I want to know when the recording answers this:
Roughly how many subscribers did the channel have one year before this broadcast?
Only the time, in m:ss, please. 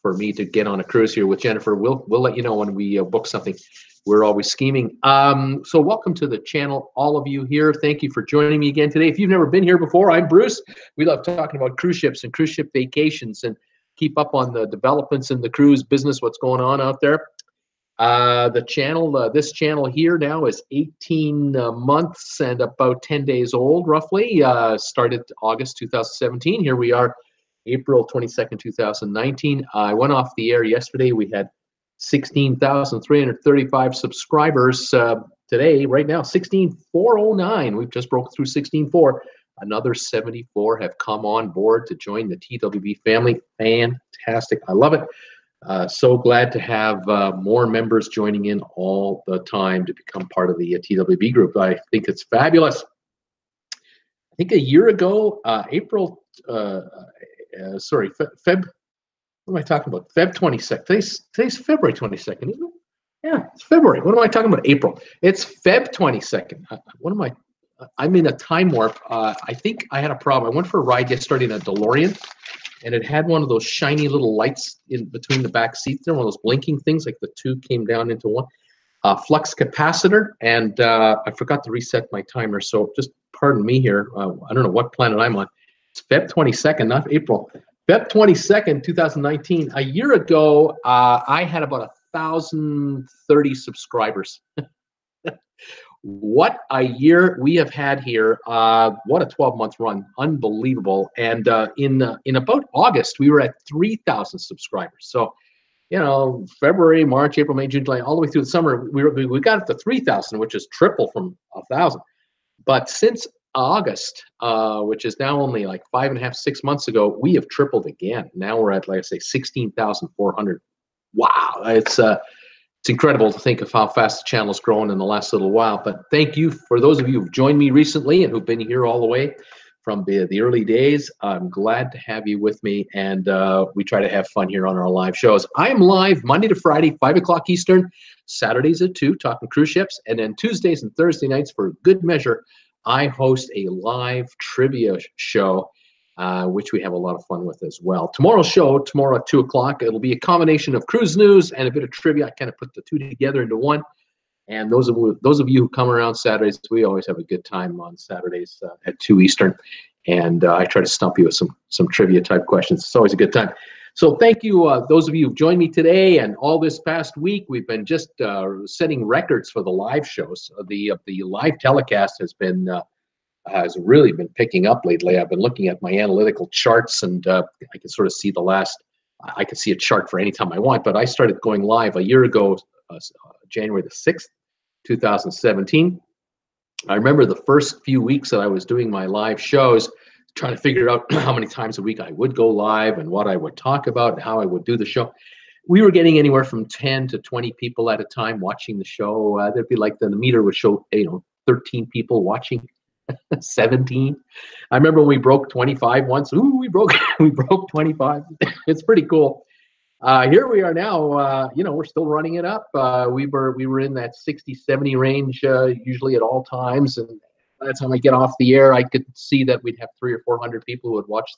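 1:32.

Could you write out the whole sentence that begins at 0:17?
Uh, the channel, uh, this channel here now is 18 uh, months and about 10 days old, roughly.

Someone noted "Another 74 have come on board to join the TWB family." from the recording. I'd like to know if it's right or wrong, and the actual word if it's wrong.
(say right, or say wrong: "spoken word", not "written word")
right.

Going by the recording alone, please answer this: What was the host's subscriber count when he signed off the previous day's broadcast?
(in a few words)
16,335.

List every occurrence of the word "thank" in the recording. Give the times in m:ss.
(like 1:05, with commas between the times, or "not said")
0:07, 2:06, 2:44.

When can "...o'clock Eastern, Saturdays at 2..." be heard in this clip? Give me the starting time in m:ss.
2:17.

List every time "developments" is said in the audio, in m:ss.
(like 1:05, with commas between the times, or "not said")
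0:14.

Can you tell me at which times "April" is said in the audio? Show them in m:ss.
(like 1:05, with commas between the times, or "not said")
0:27, 0:55, 1:04, 1:27, 1:47.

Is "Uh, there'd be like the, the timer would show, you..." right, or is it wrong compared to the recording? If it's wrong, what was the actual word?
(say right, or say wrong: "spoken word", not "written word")
wrong: "meter", not "timer".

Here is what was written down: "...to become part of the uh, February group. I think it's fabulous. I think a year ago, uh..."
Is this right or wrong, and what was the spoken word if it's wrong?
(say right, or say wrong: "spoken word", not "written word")
wrong: "TWB", not "February".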